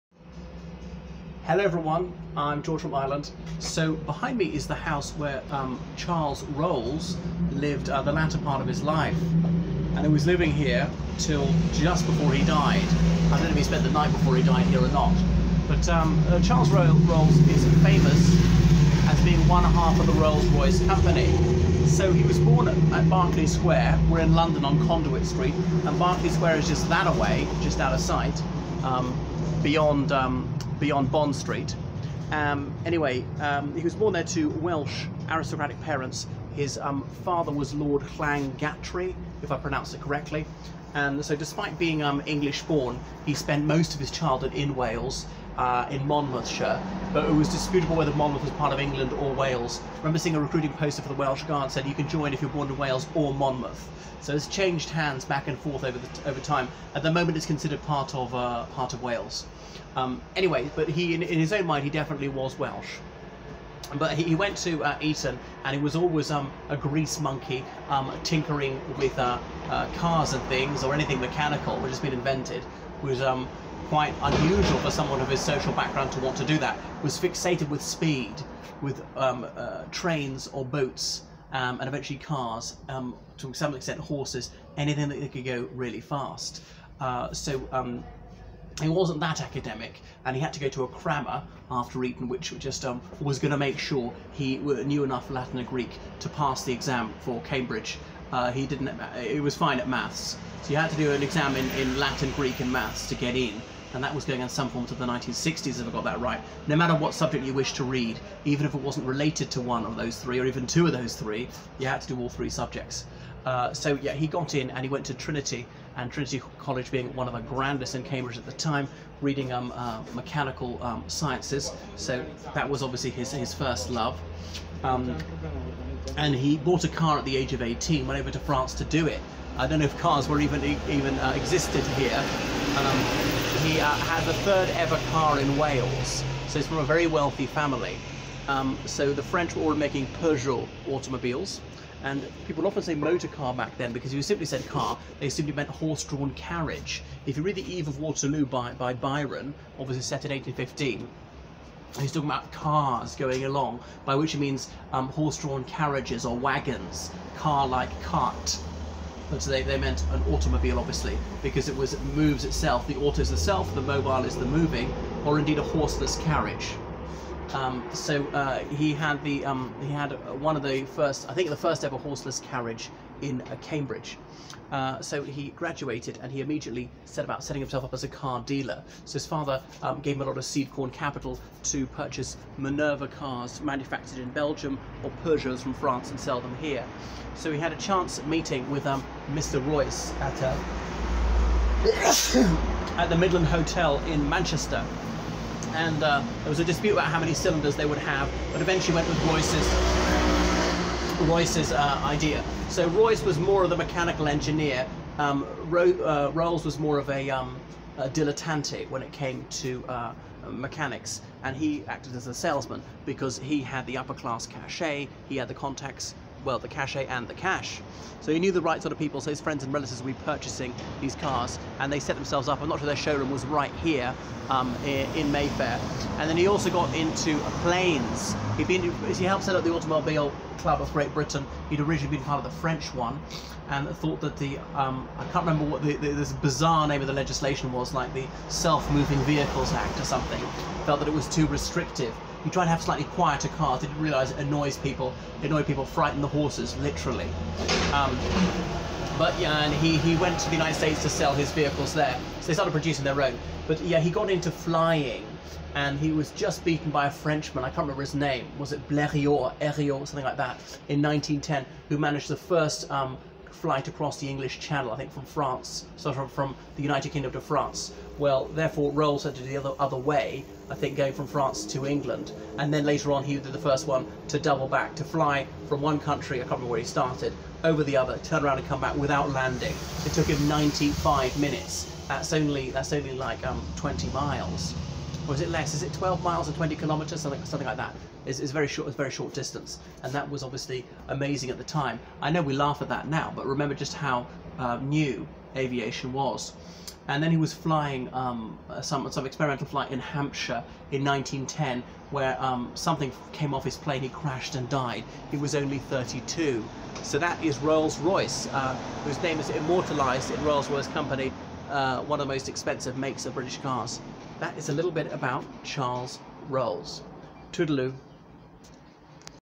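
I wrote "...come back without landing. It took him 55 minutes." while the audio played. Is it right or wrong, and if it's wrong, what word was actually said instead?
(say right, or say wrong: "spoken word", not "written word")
wrong: "95", not "55".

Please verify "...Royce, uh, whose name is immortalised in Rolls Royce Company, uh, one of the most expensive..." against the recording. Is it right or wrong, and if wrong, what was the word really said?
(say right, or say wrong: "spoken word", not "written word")
right.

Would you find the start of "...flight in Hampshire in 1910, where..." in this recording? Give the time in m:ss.
4:59.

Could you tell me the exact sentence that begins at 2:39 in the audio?
And so they, they meant an automobile, obviously, because it was moves itself.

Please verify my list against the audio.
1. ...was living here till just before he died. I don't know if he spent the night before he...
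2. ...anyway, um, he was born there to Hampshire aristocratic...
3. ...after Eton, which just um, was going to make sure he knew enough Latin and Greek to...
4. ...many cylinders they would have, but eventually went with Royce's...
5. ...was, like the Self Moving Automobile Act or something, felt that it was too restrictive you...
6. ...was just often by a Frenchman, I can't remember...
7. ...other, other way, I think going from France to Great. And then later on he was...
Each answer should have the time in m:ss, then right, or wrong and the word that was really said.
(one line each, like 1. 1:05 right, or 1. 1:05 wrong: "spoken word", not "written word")
1. 0:10 right
2. 0:32 wrong: "Welsh", not "Hampshire"
3. 1:31 right
4. 3:17 right
5. 3:57 wrong: "Vehicles", not "Automobile"
6. 4:16 wrong: "beaten", not "often"
7. 4:29 wrong: "England", not "Great".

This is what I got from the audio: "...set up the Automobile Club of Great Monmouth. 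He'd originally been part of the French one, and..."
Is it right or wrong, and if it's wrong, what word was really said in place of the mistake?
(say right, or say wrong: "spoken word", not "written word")
wrong: "Britain", not "Monmouth".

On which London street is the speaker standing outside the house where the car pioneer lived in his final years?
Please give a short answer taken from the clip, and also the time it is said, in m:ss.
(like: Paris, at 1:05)
Conduit Street, at 0:24.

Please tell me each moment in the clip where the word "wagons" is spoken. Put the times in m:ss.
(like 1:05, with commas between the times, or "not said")
2:36.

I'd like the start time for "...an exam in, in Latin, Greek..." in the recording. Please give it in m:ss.
1:41.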